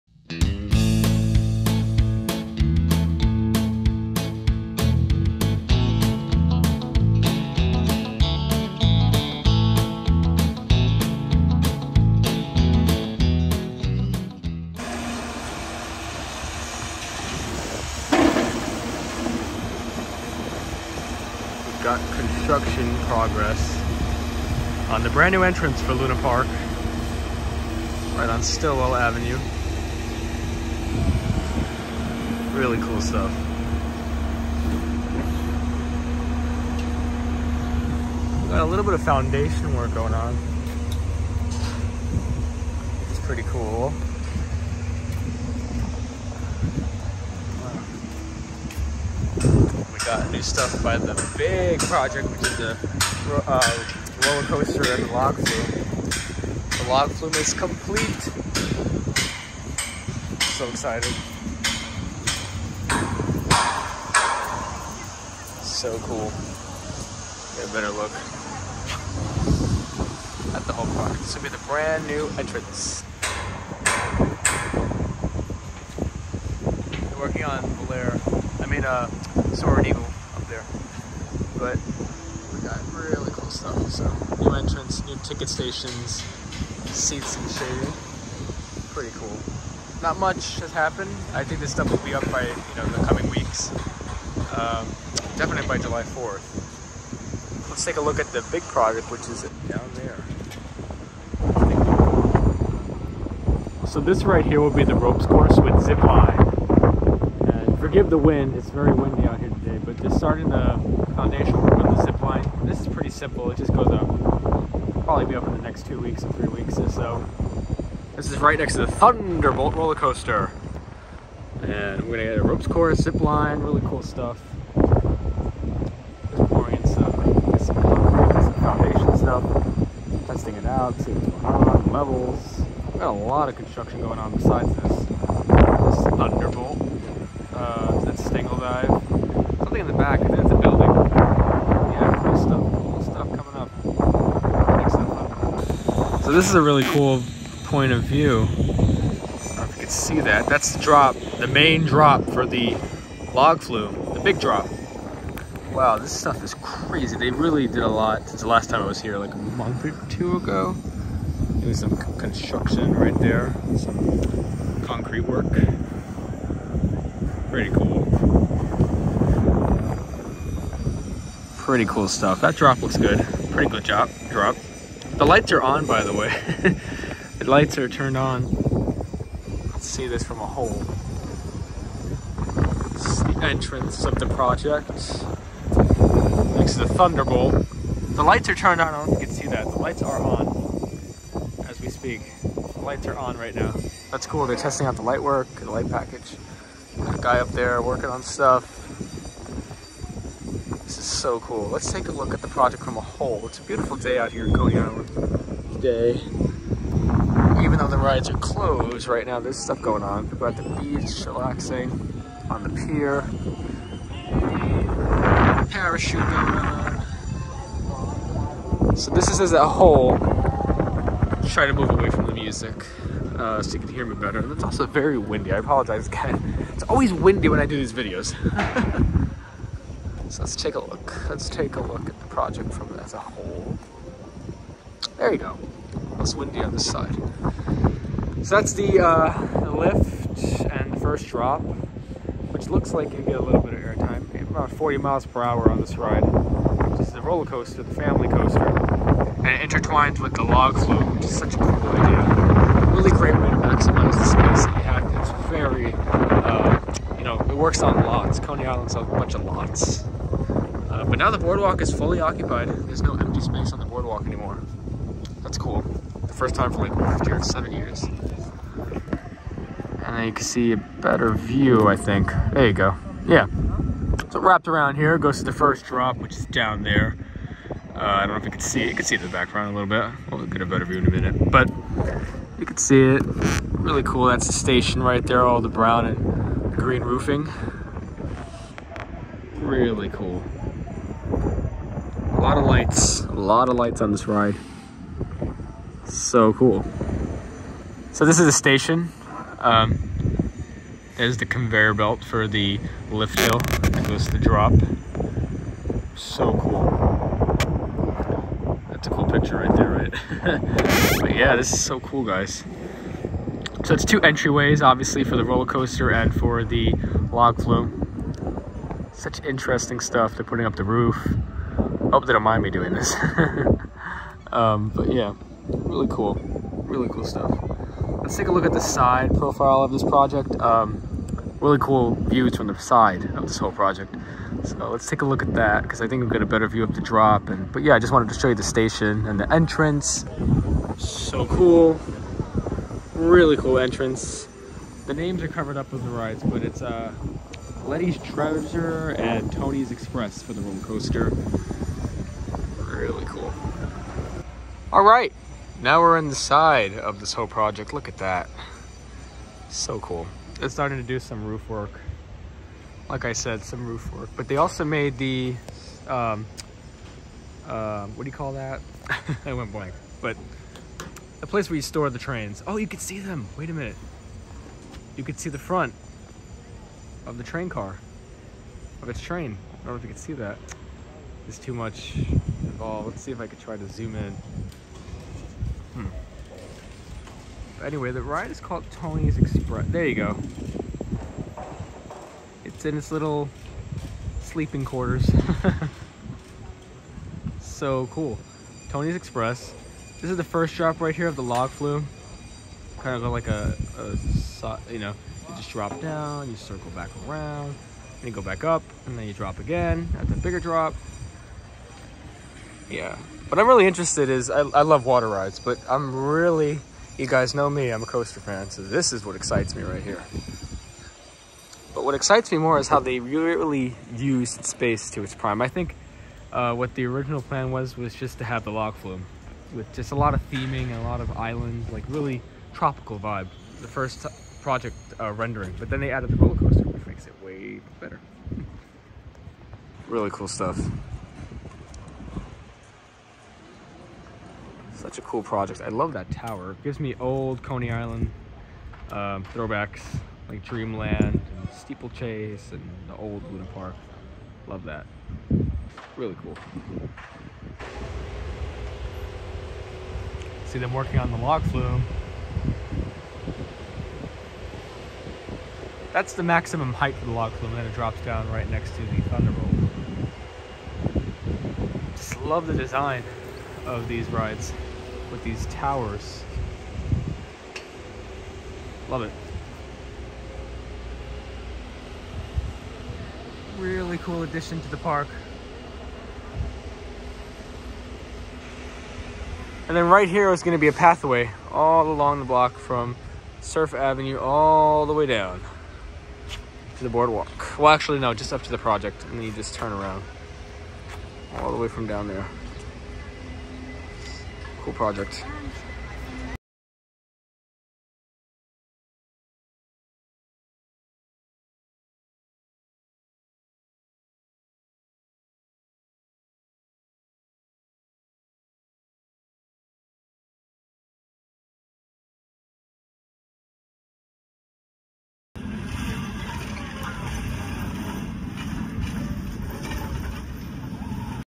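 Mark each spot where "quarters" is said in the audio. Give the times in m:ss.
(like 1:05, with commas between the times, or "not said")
6:34.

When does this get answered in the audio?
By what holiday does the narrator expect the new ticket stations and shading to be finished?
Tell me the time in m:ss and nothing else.
1:35.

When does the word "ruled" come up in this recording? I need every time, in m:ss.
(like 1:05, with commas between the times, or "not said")
not said.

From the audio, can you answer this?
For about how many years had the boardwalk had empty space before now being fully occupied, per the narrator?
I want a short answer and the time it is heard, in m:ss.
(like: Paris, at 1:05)
7, at 4:27.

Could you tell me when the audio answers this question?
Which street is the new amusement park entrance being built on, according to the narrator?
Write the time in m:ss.
0:28.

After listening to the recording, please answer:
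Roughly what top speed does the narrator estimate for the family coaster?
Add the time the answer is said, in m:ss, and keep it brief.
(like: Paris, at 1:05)
40 miles per hour, at 4:04.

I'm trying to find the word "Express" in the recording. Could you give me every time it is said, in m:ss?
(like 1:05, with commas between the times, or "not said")
5:49, 6:29, 6:39.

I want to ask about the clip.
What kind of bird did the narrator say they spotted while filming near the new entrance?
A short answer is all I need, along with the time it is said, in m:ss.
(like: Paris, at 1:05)
An eagle, at 1:19.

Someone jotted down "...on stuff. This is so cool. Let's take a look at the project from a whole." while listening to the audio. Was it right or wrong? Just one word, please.
right.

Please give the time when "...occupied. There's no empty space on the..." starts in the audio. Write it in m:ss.
4:22.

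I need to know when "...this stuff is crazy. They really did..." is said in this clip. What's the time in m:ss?
2:35.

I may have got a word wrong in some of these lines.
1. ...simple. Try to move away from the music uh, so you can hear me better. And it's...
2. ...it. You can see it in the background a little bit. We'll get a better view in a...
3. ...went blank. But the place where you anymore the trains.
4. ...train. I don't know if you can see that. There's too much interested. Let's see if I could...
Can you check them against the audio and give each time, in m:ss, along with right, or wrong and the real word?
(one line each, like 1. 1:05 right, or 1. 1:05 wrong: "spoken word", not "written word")
1. 3:39 wrong: "whole", not "simple"
2. 4:38 right
3. 6:09 wrong: "store", not "anymore"
4. 6:19 wrong: "involved", not "interested".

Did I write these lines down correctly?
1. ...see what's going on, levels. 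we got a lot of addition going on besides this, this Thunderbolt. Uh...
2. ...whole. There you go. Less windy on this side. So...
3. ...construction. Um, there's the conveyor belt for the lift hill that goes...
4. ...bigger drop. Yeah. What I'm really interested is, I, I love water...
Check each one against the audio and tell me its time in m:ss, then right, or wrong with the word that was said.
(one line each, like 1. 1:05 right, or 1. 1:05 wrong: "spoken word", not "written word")
1. 2:11 wrong: "construction", not "addition"
2. 3:53 right
3. 4:58 wrong: "station", not "construction"
4. 6:50 right.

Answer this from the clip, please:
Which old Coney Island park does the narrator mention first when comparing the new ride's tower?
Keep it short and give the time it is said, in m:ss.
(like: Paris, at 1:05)
Dreamland, at 7:30.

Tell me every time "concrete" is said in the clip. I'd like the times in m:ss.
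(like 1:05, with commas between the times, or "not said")
2:07, 2:44.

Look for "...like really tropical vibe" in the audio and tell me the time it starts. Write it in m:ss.
7:11.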